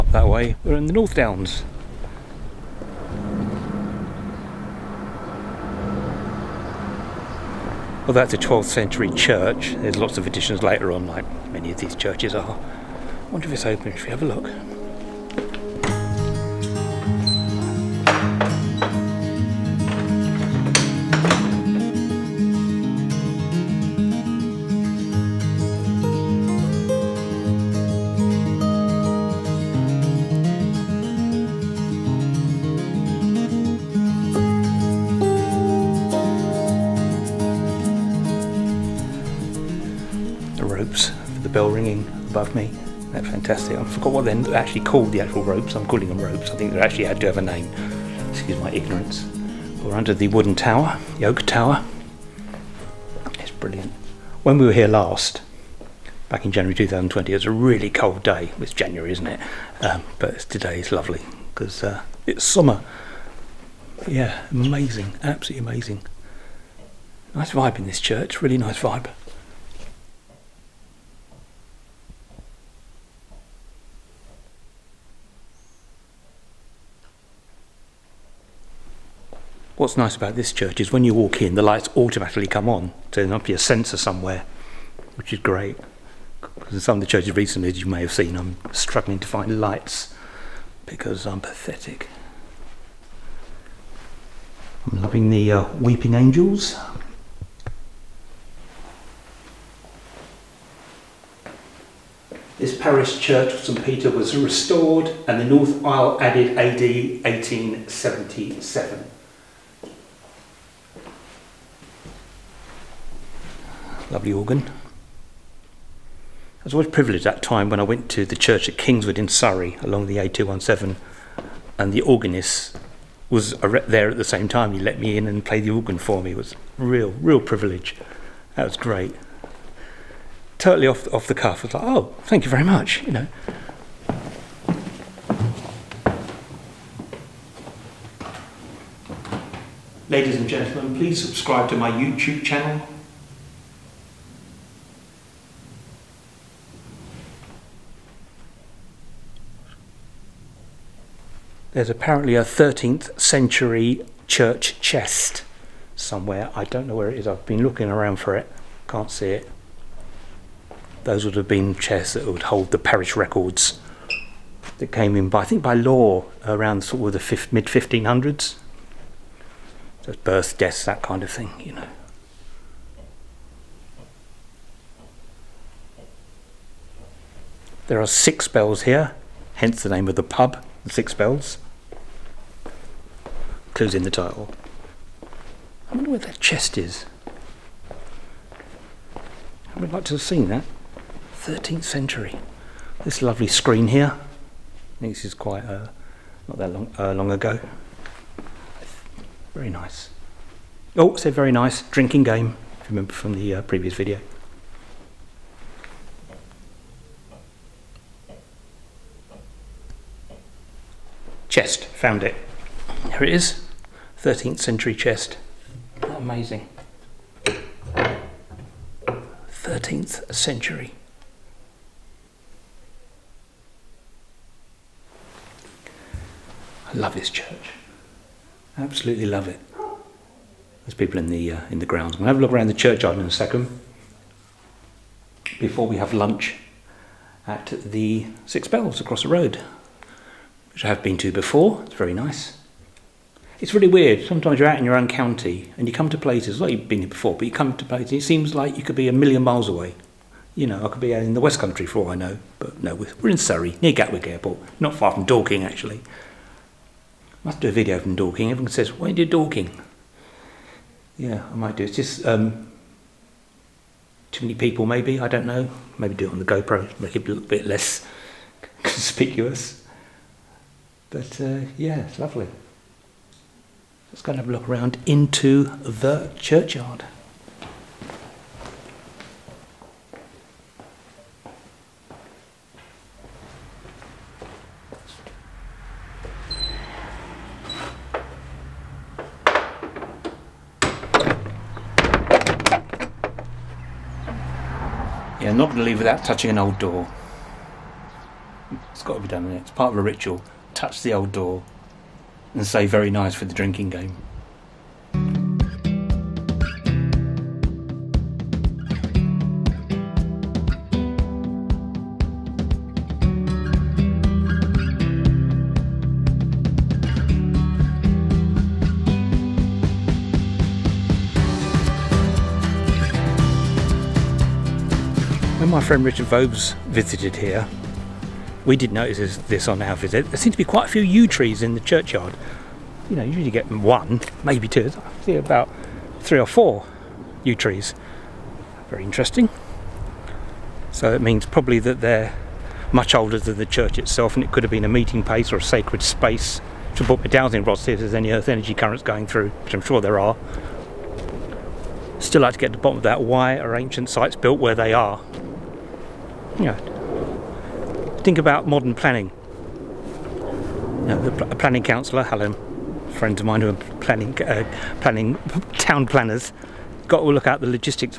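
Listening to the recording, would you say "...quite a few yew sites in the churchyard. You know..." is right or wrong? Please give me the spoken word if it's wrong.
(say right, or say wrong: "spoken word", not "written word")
wrong: "trees", not "sites".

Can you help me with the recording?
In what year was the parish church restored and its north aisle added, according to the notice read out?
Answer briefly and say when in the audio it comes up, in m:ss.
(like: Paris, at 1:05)
1877, at 1:46.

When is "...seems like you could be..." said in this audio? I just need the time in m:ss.
4:08.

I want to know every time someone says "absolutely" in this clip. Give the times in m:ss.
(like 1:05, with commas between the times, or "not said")
1:05, 3:48.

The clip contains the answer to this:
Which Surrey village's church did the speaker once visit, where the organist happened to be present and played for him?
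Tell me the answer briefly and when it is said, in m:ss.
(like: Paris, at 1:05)
Kingswood, at 1:58.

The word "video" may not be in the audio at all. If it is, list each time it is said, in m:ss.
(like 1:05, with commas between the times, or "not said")
3:23, 4:17.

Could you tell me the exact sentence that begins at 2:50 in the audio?
So births, deaths, that kind of thing, you know.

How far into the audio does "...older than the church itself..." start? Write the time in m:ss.
5:43.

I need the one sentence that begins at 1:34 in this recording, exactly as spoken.
I'm loving the uh, weeping angels.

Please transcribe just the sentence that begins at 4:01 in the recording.
It's very nice it's really weird.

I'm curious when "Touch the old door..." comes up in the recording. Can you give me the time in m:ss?
5:00.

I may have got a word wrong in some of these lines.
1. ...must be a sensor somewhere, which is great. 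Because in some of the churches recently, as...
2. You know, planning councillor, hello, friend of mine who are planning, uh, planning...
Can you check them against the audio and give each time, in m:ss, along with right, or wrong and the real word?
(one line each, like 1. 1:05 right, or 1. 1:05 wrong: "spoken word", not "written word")
1. 1:23 right
2. 6:01 right.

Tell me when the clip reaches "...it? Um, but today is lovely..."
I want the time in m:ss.
0:59.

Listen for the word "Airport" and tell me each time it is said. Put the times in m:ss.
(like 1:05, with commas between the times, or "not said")
4:14.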